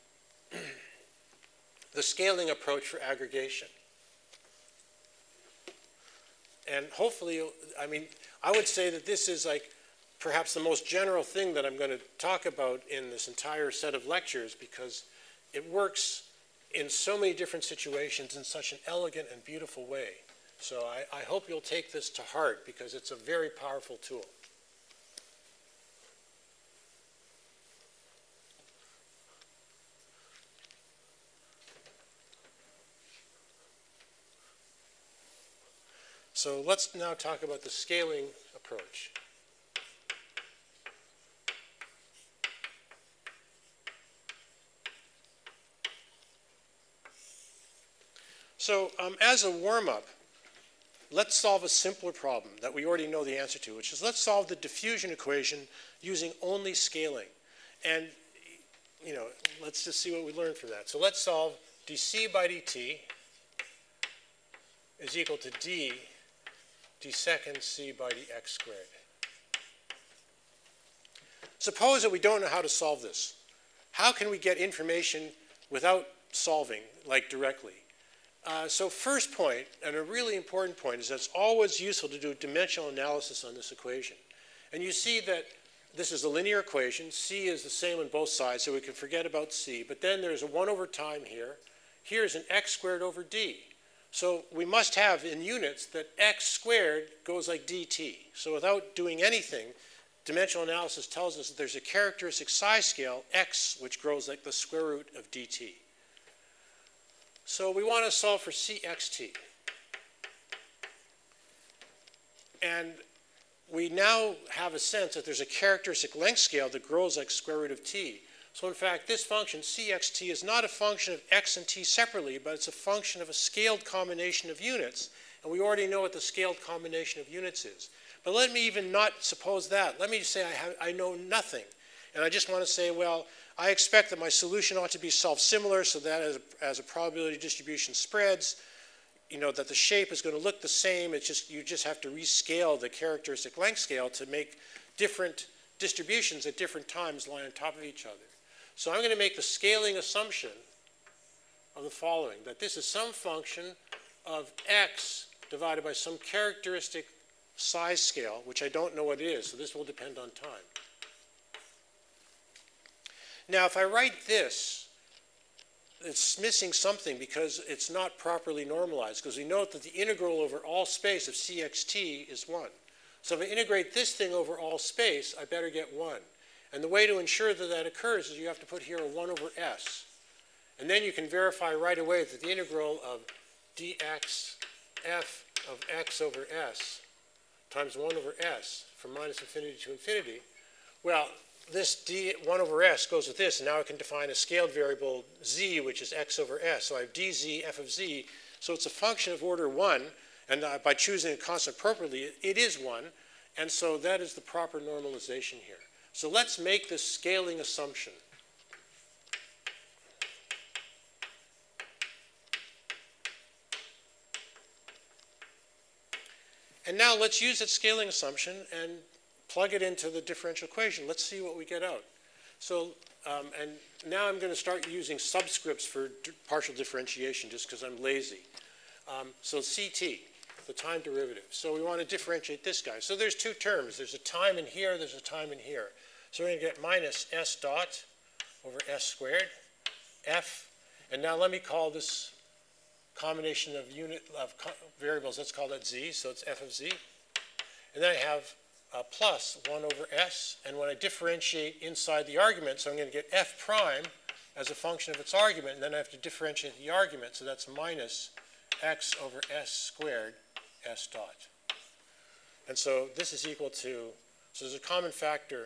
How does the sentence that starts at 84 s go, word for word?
And you see that this is a linear equation.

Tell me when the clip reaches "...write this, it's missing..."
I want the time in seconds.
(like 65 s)
163 s.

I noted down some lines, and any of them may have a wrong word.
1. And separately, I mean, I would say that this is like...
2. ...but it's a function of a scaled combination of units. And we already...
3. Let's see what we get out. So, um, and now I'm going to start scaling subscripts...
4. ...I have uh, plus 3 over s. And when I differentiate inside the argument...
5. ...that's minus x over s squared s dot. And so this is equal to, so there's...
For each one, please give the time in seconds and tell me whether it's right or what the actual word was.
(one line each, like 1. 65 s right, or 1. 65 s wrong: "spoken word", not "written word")
1. 6 s wrong: "hopefully", not "separately"
2. 122 s right
3. 221 s wrong: "using", not "scaling"
4. 248 s wrong: "1", not "3"
5. 257 s right.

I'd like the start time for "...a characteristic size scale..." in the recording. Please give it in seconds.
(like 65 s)
101 s.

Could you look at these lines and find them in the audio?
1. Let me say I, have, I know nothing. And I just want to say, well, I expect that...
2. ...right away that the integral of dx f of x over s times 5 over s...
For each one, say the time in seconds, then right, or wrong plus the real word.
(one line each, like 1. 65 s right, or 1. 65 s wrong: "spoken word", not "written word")
1. 129 s right
2. 181 s wrong: "1", not "5".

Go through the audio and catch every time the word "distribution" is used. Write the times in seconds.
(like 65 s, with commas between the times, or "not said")
137 s, 145 s.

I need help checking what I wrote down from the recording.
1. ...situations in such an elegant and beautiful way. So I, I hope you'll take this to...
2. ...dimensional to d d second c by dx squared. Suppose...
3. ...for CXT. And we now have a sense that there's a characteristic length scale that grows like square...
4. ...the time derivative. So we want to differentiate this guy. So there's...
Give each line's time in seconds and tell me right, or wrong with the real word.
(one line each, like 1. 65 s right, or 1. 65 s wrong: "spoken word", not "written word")
1. 17 s right
2. 65 s wrong: "equal", not "dimensional"
3. 108 s right
4. 230 s right.